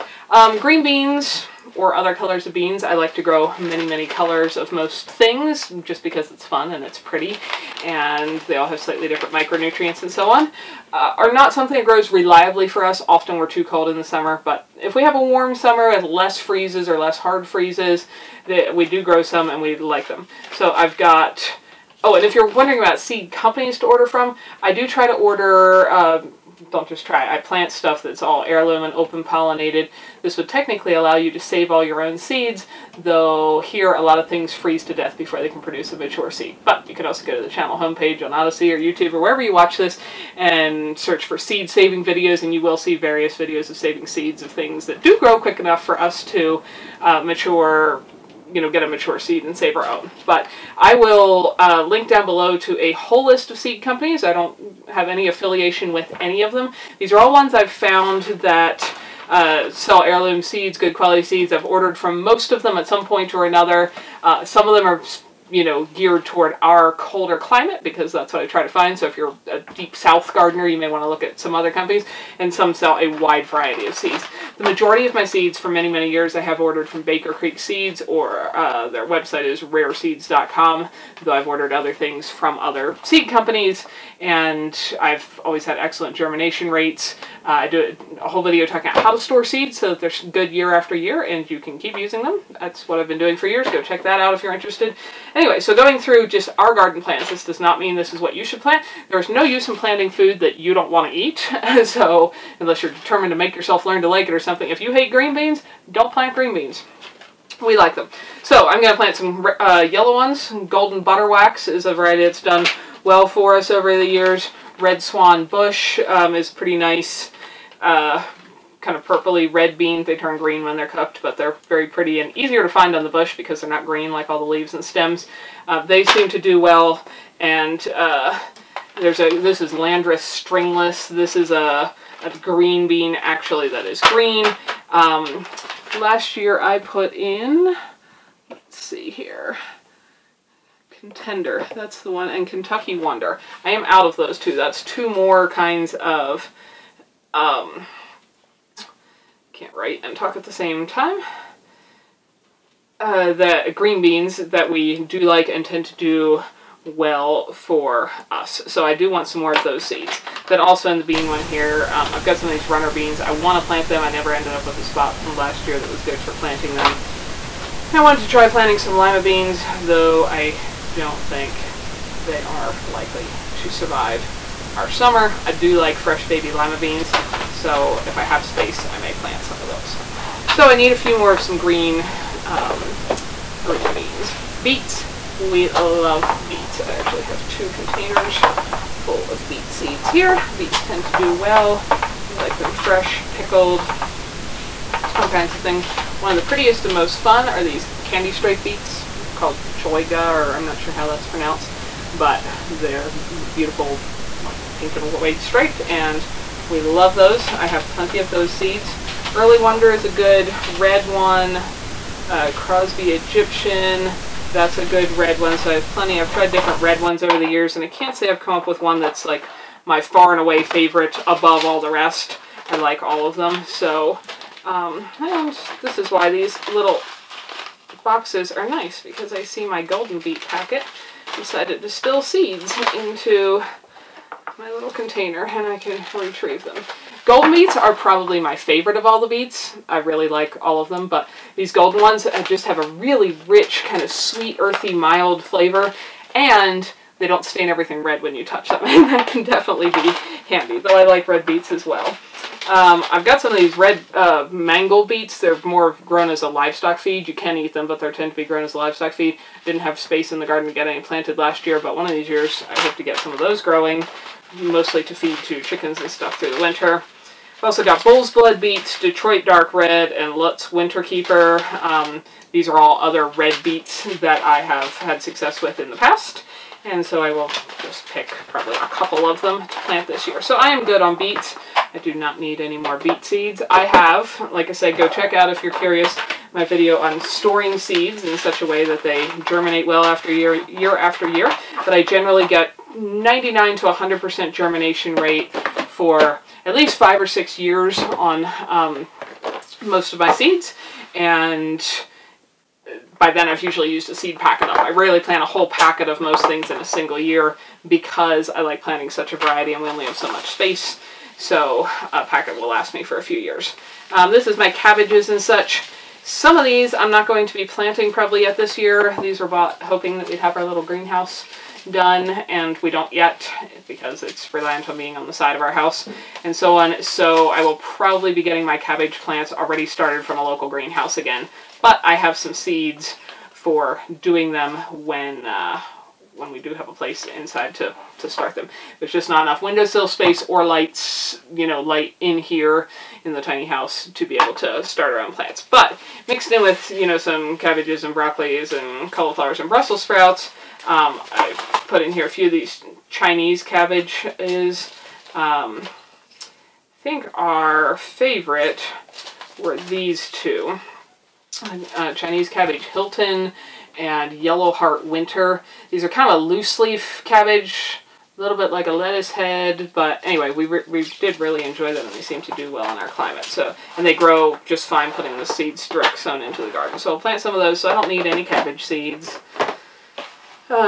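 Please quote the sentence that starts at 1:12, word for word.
And some sell a wide variety of seeds.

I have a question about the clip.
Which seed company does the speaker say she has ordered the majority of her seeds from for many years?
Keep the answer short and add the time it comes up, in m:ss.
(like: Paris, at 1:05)
Baker Creek Seeds, at 1:17.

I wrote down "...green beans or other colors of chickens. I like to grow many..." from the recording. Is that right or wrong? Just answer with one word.
wrong.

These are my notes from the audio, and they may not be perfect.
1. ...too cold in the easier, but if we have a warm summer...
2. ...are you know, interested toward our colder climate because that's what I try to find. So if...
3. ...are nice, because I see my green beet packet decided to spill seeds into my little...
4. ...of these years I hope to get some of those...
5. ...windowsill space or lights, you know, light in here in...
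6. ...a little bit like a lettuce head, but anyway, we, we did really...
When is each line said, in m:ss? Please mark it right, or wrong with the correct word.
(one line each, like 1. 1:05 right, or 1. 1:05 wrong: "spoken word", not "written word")
1. 0:13 wrong: "summer", not "easier"
2. 1:04 wrong: "geared", not "interested"
3. 3:48 wrong: "golden", not "green"
4. 4:22 right
5. 5:39 right
6. 6:08 right.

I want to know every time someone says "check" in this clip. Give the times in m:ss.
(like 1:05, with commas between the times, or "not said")
1:33, 4:45.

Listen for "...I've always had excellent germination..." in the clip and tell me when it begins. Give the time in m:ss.
1:25.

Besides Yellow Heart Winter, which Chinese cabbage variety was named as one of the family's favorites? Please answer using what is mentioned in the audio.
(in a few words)
Hilton.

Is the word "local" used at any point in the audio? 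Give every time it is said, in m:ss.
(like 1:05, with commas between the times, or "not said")
5:30.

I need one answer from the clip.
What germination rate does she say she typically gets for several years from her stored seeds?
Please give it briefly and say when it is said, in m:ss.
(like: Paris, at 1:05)
99 to 100%, at 4:52.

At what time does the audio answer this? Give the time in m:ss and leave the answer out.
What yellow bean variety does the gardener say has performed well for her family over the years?
1:50.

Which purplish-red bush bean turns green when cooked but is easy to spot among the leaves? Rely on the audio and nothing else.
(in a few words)
Red swan.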